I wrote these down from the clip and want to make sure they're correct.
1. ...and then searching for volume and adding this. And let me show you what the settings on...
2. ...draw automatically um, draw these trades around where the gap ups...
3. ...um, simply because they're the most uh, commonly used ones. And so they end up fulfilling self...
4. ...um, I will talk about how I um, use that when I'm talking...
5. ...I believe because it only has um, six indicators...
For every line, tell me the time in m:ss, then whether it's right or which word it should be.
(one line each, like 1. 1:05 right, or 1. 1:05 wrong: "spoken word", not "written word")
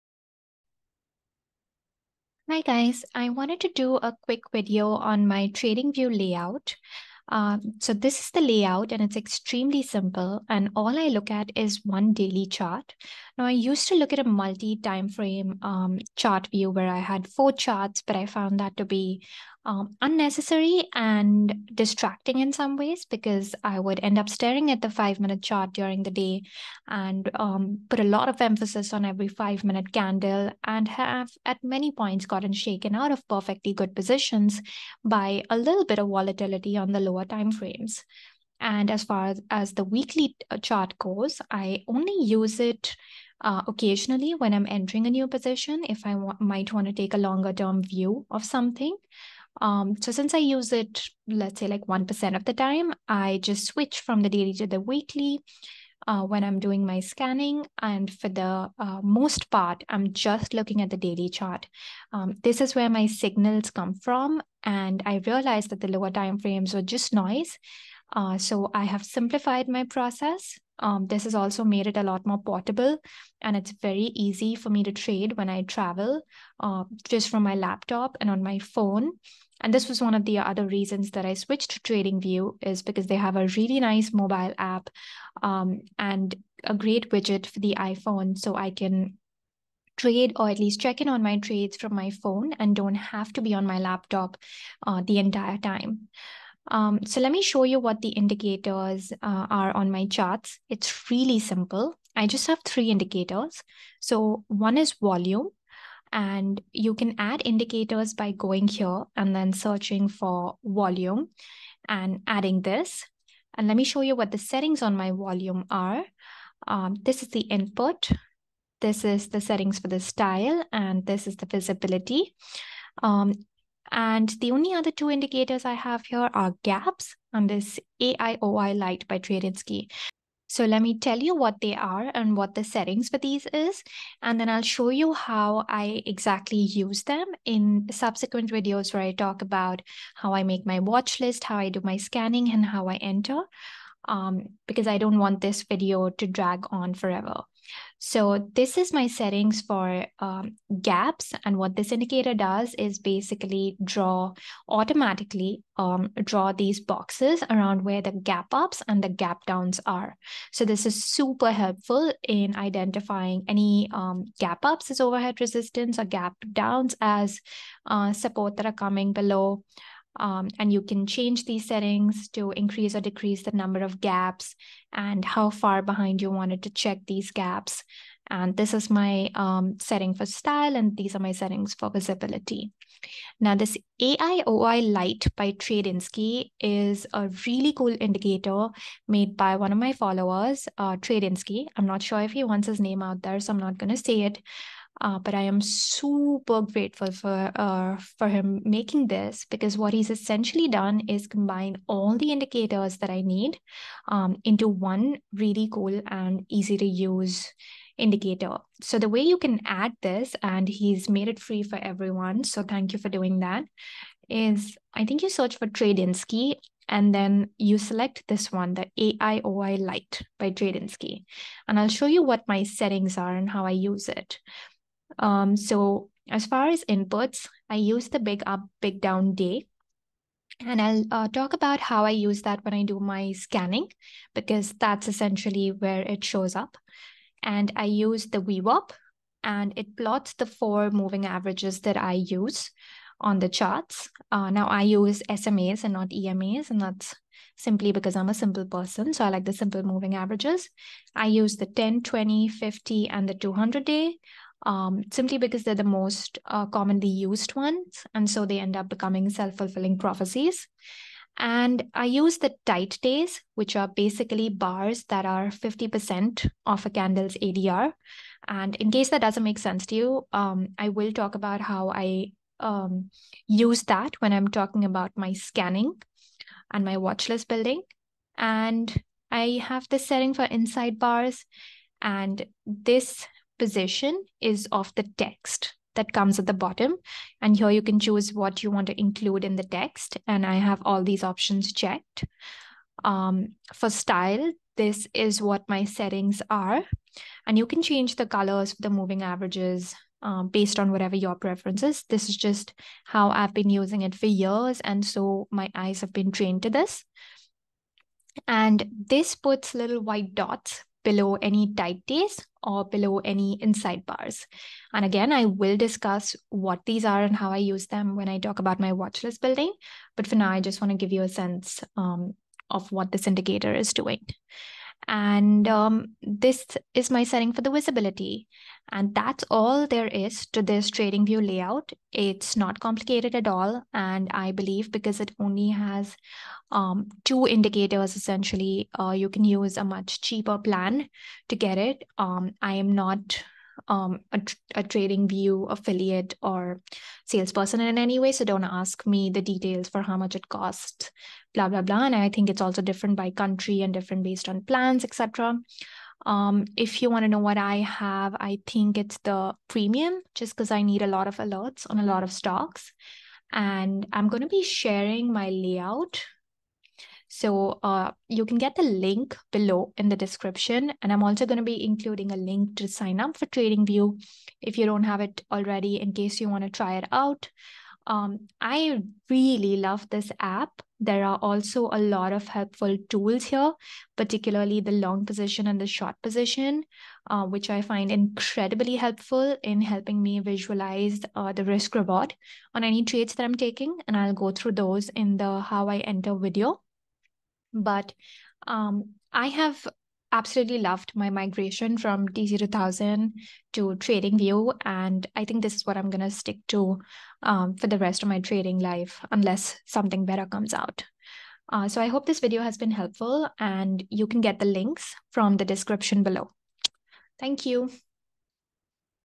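1. 1:49 right
2. 2:33 wrong: "boxes", not "trades"
3. 4:14 wrong: "becoming", not "fulfilling"
4. 4:30 right
5. 5:34 wrong: "two", not "six".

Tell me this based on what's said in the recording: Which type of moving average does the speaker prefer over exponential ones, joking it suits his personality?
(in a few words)
SMAs.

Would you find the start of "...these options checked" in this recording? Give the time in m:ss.
4:51.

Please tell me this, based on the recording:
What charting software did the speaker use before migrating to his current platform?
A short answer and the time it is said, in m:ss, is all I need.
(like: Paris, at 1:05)
TC2000, at 6:42.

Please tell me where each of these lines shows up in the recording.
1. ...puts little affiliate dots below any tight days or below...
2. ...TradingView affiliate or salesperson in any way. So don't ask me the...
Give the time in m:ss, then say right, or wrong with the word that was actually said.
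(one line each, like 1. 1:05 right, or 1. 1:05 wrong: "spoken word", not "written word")
1. 5:09 wrong: "white", not "affiliate"
2. 5:44 right.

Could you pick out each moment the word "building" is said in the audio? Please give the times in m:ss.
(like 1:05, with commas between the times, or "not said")
4:37, 5:19.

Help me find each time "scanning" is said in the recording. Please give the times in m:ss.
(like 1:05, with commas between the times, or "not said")
0:56, 2:21, 3:53, 4:35.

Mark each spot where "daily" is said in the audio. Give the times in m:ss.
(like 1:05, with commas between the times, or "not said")
0:12, 0:54, 1:00.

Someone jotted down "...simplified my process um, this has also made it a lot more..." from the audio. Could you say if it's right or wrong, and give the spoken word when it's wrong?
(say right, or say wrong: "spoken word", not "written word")
right.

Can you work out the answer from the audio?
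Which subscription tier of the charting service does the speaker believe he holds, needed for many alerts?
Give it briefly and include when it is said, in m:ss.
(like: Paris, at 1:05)
premium, at 5:59.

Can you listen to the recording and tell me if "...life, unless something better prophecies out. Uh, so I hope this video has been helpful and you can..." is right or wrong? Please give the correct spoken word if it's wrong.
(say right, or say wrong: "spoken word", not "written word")
wrong: "comes", not "prophecies".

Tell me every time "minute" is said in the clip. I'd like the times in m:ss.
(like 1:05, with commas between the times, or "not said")
0:25, 0:29.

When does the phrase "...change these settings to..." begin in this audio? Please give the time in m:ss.
2:51.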